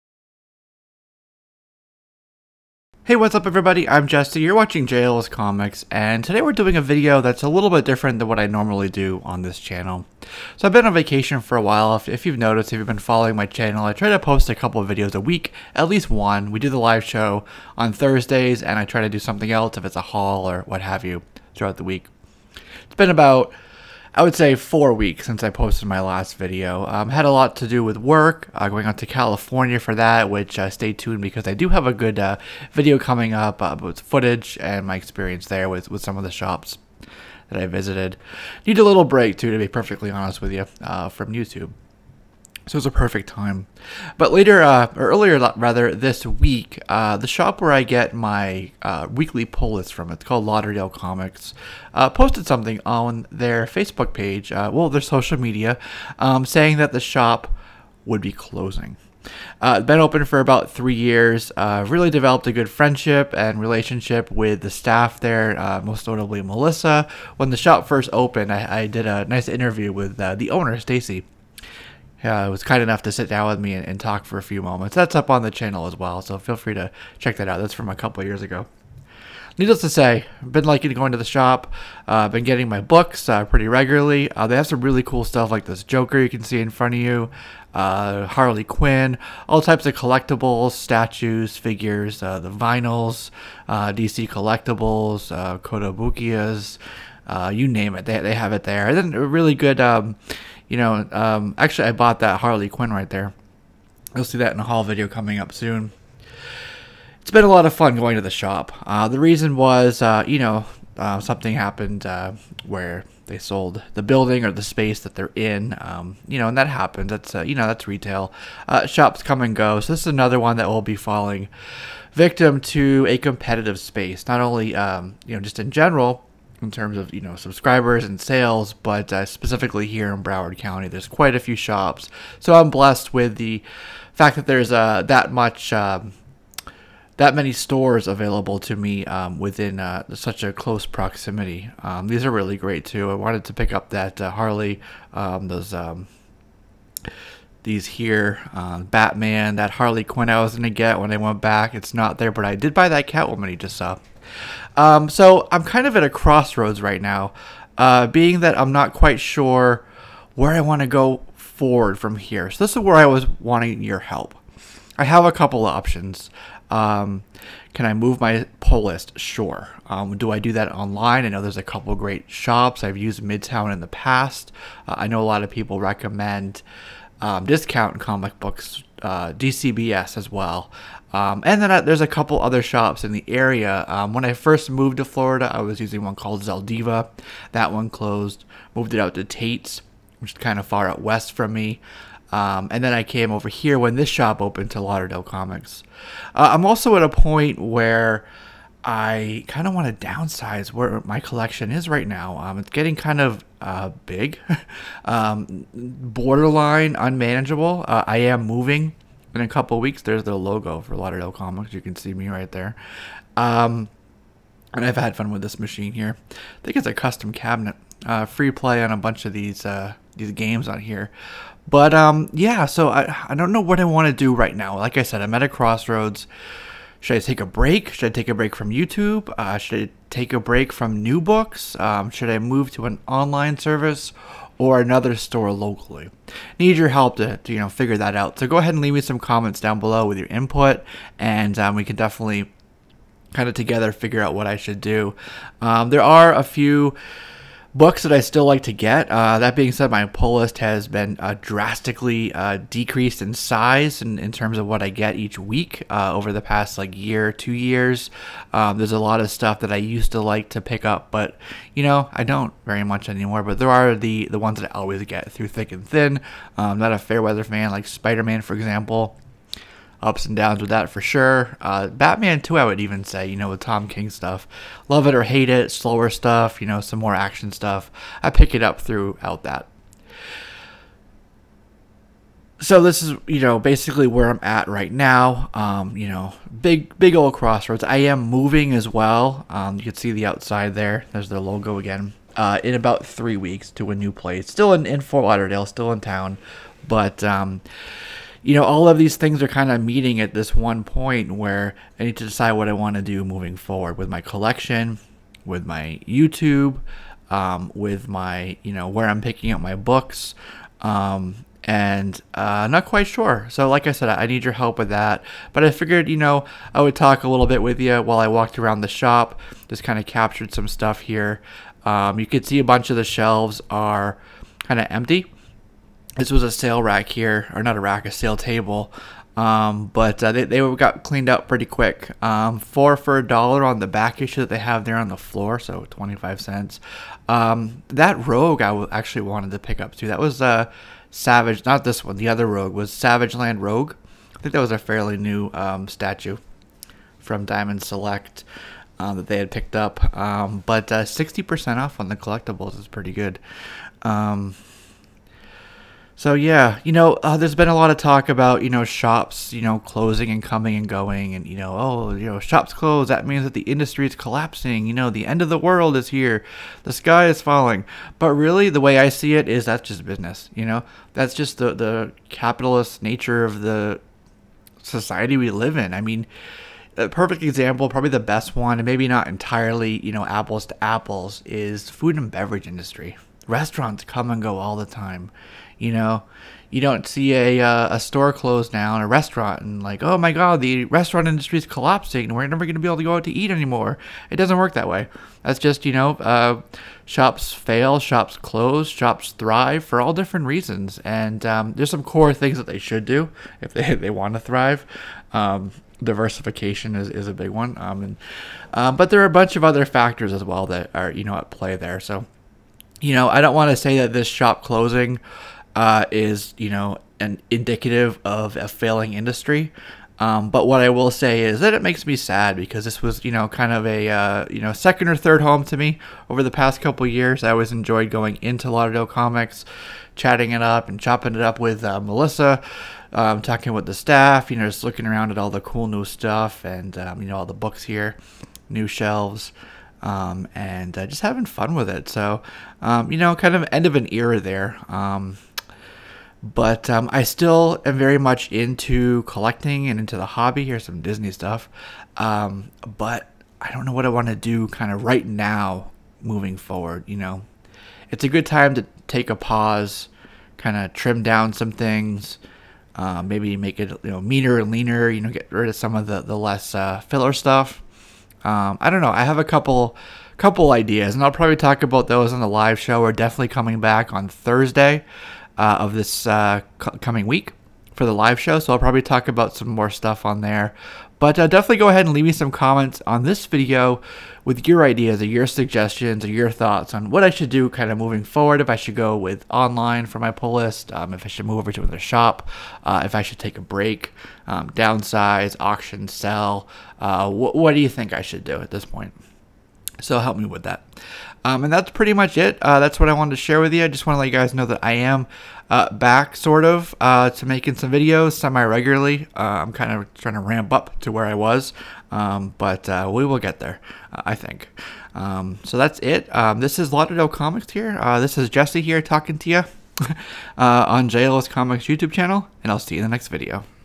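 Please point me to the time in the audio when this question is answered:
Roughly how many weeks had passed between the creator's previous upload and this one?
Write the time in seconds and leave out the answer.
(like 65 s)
24 s.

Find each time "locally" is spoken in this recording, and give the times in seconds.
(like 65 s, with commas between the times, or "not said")
235 s.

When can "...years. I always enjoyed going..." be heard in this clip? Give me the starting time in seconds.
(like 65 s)
427 s.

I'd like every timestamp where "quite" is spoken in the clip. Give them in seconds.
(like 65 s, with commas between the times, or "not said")
131 s, 158 s, 312 s.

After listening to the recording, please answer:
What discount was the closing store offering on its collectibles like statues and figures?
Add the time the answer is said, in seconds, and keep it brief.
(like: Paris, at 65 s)
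60%, at 350 s.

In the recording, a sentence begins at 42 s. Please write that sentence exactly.
So it was a perfect time.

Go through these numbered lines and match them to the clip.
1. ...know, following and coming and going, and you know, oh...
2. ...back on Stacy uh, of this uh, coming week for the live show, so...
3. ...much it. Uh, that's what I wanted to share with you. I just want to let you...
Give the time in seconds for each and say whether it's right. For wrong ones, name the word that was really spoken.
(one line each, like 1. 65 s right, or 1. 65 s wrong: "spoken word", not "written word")
1. 359 s wrong: "closing", not "following"
2. 473 s wrong: "Thursday", not "Stacy"
3. 502 s right.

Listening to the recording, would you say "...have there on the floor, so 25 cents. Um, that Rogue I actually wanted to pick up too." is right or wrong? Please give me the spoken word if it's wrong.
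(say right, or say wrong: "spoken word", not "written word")
right.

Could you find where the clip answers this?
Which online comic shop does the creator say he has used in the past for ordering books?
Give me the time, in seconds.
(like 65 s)
173 s.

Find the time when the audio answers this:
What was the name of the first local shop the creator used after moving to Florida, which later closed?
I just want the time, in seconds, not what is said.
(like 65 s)
186 s.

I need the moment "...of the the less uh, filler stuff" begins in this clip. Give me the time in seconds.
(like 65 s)
465 s.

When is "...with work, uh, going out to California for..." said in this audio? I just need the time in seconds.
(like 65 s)
27 s.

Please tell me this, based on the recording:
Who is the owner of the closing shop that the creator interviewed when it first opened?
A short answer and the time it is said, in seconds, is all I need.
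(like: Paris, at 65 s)
Stacy, at 70 s.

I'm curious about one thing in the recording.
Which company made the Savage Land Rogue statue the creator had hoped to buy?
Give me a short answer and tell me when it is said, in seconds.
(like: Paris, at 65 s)
Diamond Select, at 347 s.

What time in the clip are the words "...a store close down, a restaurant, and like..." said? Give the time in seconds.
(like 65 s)
387 s.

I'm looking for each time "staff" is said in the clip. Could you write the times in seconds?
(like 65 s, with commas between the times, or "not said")
64 s, 433 s.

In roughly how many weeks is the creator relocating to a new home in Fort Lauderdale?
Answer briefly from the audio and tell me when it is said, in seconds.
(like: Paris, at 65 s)
3, at 293 s.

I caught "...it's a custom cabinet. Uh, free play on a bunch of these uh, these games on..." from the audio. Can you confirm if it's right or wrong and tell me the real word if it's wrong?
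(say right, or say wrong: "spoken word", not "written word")
right.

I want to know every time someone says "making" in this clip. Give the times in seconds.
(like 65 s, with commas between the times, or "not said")
507 s.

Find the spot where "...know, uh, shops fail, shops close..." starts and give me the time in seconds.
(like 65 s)
395 s.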